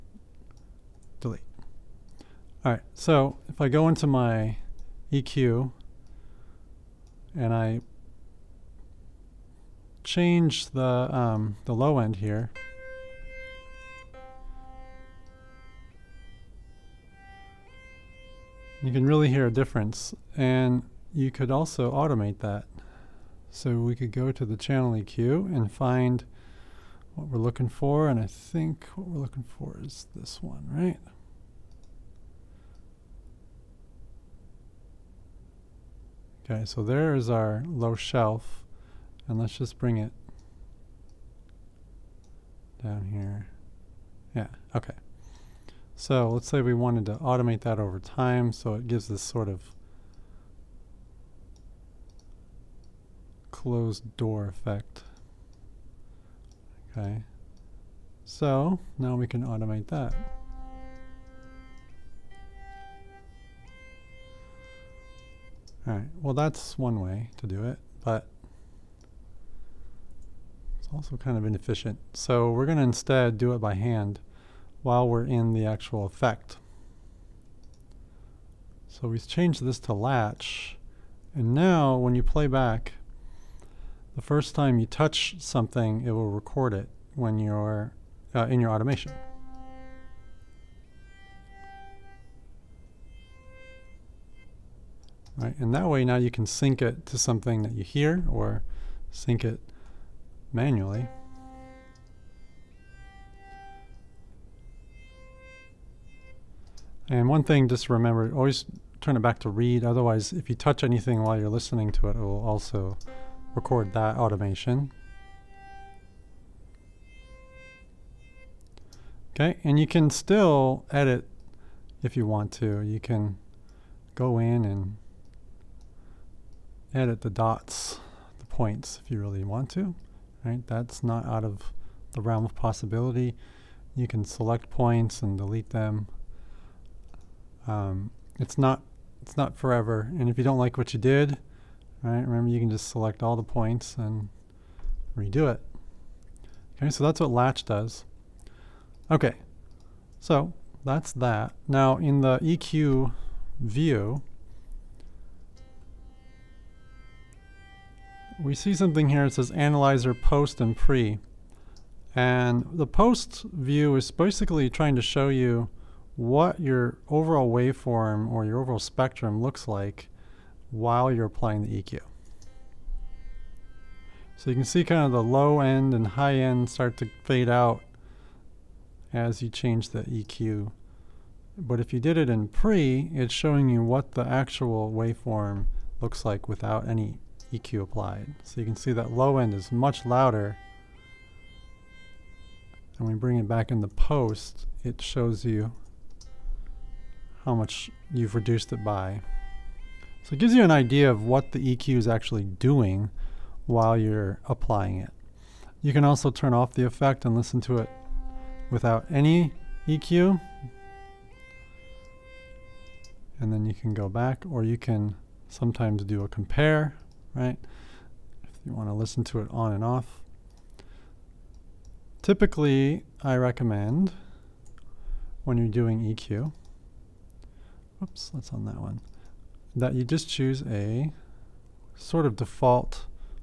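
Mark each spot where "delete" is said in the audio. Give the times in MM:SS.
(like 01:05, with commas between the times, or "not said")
00:01, 02:15.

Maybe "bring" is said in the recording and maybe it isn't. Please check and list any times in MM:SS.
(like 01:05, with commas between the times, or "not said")
00:39, 03:13.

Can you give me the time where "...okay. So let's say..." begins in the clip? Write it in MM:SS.
00:44.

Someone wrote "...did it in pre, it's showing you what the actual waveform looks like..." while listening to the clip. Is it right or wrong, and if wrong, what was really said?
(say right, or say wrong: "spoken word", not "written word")
right.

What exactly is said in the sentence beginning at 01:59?
Okay, and you can still edit if you want to.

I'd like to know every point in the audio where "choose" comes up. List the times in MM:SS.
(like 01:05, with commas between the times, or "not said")
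03:50.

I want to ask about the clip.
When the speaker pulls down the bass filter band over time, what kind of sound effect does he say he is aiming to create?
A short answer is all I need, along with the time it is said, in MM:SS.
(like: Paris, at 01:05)
closed door effect, at 00:53.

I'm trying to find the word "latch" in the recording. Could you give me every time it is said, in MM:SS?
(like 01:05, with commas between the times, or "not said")
01:19, 02:27.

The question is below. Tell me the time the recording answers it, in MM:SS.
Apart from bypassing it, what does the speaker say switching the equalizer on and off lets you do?
03:36.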